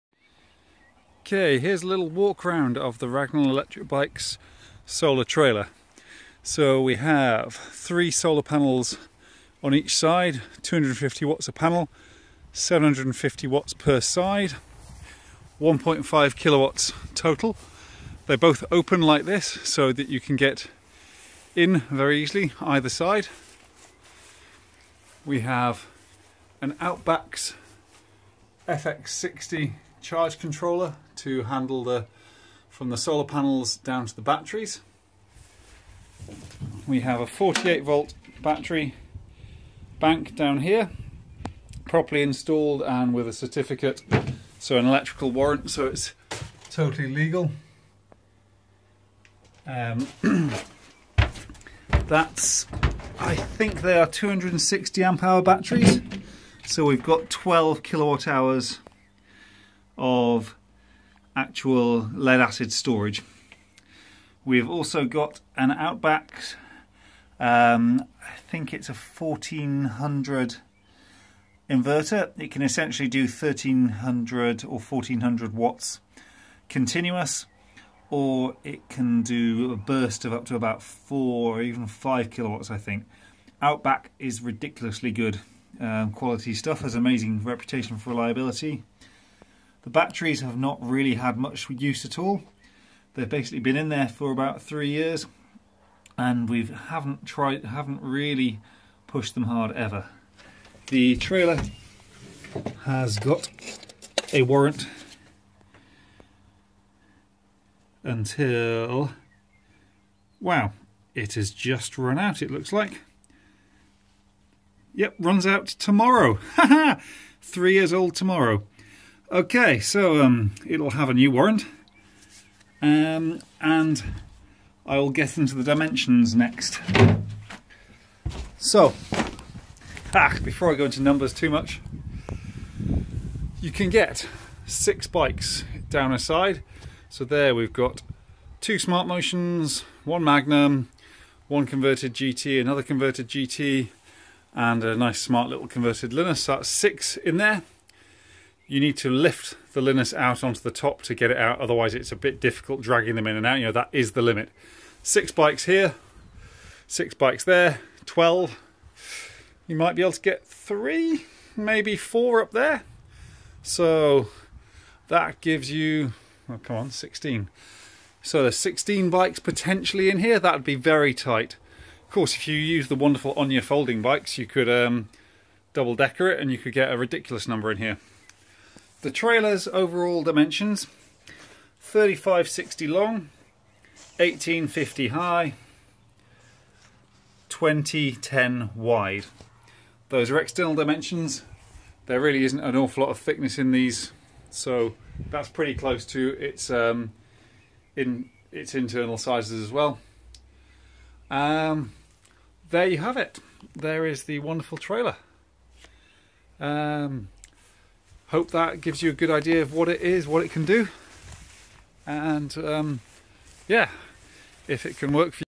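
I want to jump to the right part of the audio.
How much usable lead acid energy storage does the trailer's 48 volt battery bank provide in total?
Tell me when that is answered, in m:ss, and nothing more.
0:57.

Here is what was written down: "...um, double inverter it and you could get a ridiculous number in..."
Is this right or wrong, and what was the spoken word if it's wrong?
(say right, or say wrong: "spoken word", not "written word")
wrong: "decker", not "inverter".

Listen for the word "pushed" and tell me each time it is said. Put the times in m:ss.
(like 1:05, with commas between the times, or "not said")
1:39.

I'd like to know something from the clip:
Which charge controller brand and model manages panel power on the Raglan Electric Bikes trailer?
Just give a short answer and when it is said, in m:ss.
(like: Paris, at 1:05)
Outback FX60, at 0:26.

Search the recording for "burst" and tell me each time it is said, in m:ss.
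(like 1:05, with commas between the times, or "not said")
1:19.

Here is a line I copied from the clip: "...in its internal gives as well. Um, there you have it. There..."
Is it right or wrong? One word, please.
wrong.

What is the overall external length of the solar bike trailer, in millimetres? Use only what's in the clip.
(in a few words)
3560.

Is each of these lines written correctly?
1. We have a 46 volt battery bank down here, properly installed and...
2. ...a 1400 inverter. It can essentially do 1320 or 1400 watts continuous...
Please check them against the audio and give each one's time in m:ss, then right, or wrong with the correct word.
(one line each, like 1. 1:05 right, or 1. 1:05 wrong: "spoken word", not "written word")
1. 0:36 wrong: "48", not "46"
2. 1:08 wrong: "1300", not "1320".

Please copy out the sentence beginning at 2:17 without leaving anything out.
So there we've got two Smart Motions, one Magnum, one converted GT, another converted GT, and a nice smart little converted Linus.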